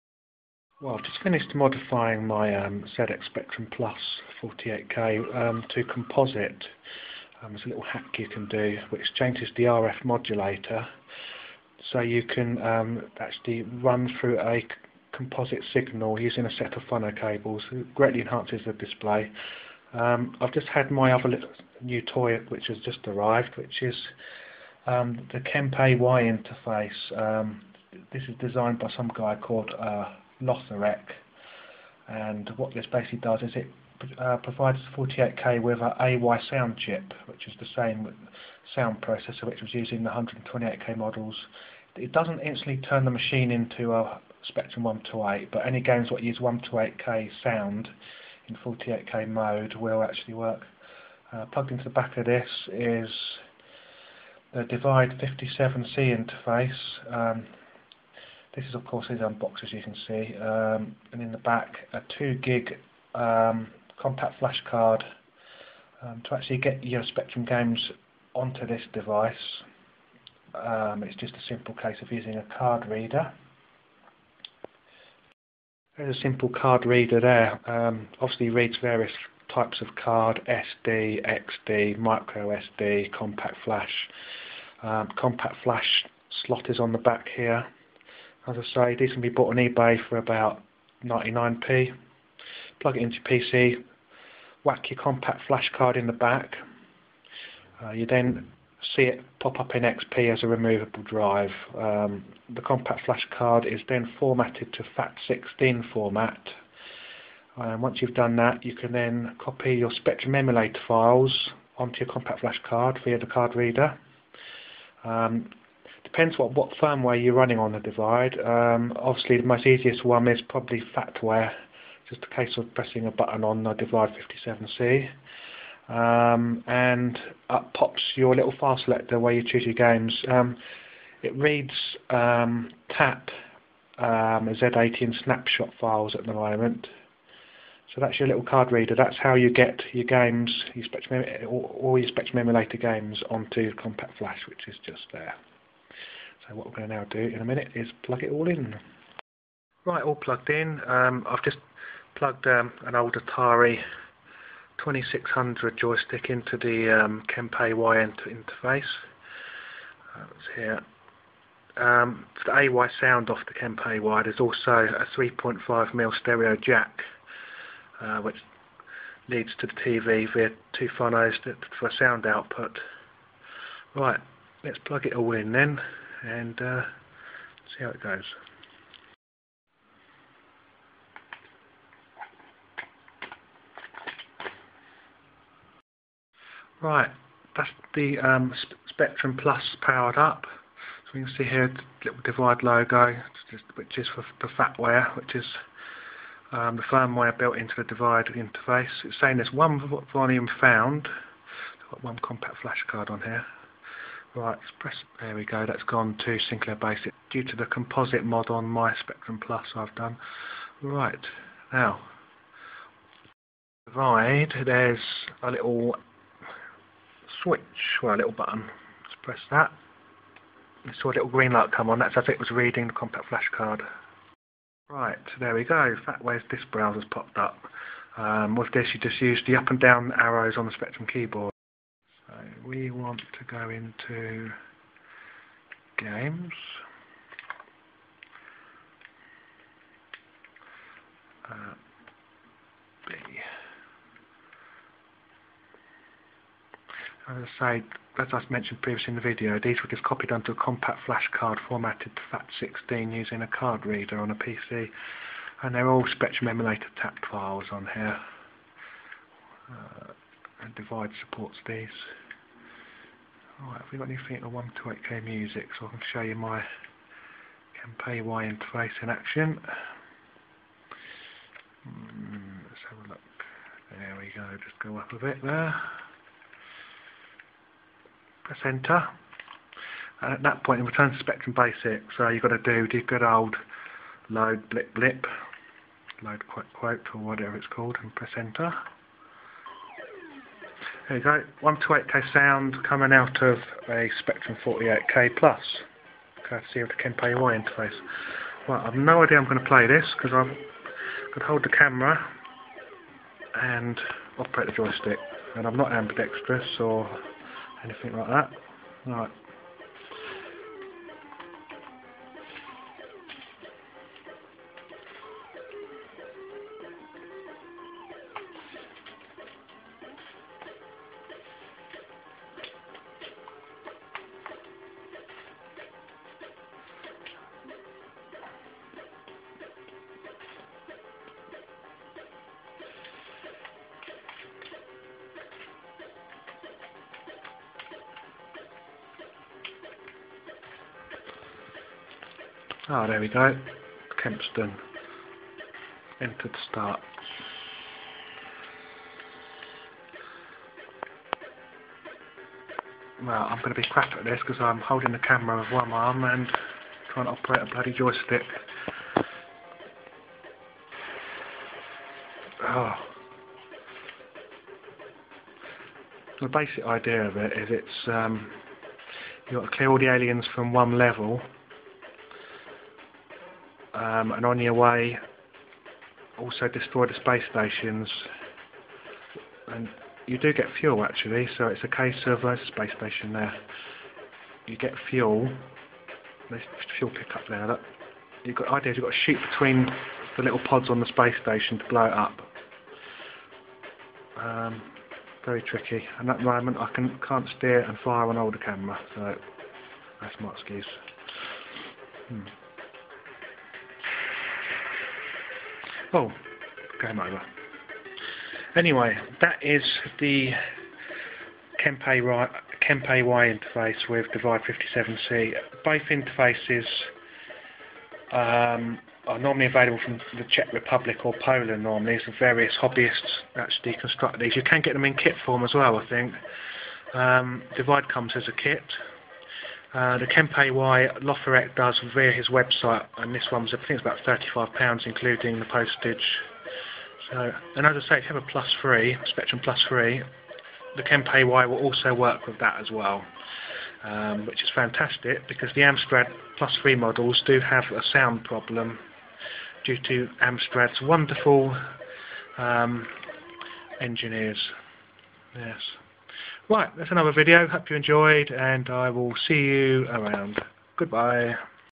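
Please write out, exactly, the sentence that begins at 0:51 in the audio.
Uh, plugged into the back of this is the Divide 57C interface.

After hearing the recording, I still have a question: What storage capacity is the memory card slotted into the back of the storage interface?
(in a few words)
2 gig.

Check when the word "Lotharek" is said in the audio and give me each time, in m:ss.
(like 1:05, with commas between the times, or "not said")
0:30, 7:11.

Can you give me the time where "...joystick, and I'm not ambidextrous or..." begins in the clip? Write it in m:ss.
5:04.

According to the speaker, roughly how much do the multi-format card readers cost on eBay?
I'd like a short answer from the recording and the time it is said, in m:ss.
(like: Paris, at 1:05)
99p, at 1:31.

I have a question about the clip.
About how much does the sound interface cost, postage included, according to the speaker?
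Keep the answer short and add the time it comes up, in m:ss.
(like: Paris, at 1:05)
£35, at 7:14.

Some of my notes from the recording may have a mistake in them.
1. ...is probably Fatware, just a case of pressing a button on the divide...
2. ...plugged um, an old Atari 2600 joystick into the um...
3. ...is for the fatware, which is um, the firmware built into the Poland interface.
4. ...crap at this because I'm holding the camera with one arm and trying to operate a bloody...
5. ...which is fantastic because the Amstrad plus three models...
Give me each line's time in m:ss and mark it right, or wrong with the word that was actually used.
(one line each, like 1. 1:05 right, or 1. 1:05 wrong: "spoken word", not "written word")
1. 2:00 right
2. 2:32 right
3. 3:13 wrong: "Divide", not "Poland"
4. 5:53 right
5. 7:24 right.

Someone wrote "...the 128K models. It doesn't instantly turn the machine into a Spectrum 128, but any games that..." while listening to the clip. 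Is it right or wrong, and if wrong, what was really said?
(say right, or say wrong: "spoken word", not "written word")
right.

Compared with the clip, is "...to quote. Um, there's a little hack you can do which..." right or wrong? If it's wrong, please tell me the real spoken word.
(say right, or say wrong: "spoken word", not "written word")
wrong: "composite", not "quote".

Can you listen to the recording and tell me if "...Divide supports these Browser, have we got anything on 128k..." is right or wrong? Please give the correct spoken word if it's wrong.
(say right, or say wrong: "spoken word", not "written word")
wrong: "Right", not "Browser".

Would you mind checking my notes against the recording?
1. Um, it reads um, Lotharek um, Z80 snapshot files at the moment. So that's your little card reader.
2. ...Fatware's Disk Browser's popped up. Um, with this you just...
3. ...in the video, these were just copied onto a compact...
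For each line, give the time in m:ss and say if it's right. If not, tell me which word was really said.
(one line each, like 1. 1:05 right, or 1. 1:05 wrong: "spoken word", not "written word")
1. 2:10 wrong: "TAP", not "Lotharek"
2. 3:46 right
3. 4:09 right.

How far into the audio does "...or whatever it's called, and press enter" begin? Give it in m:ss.
4:47.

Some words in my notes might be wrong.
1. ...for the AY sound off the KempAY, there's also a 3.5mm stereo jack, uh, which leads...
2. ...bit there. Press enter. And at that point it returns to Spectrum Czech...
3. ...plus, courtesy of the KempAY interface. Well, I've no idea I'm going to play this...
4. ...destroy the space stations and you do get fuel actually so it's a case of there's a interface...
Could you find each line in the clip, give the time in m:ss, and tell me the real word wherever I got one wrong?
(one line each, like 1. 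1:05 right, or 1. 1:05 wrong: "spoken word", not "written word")
1. 2:42 right
2. 4:35 wrong: "Basic", not "Czech"
3. 4:55 right
4. 6:16 wrong: "space", not "interface".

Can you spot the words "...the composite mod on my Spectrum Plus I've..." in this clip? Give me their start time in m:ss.
3:27.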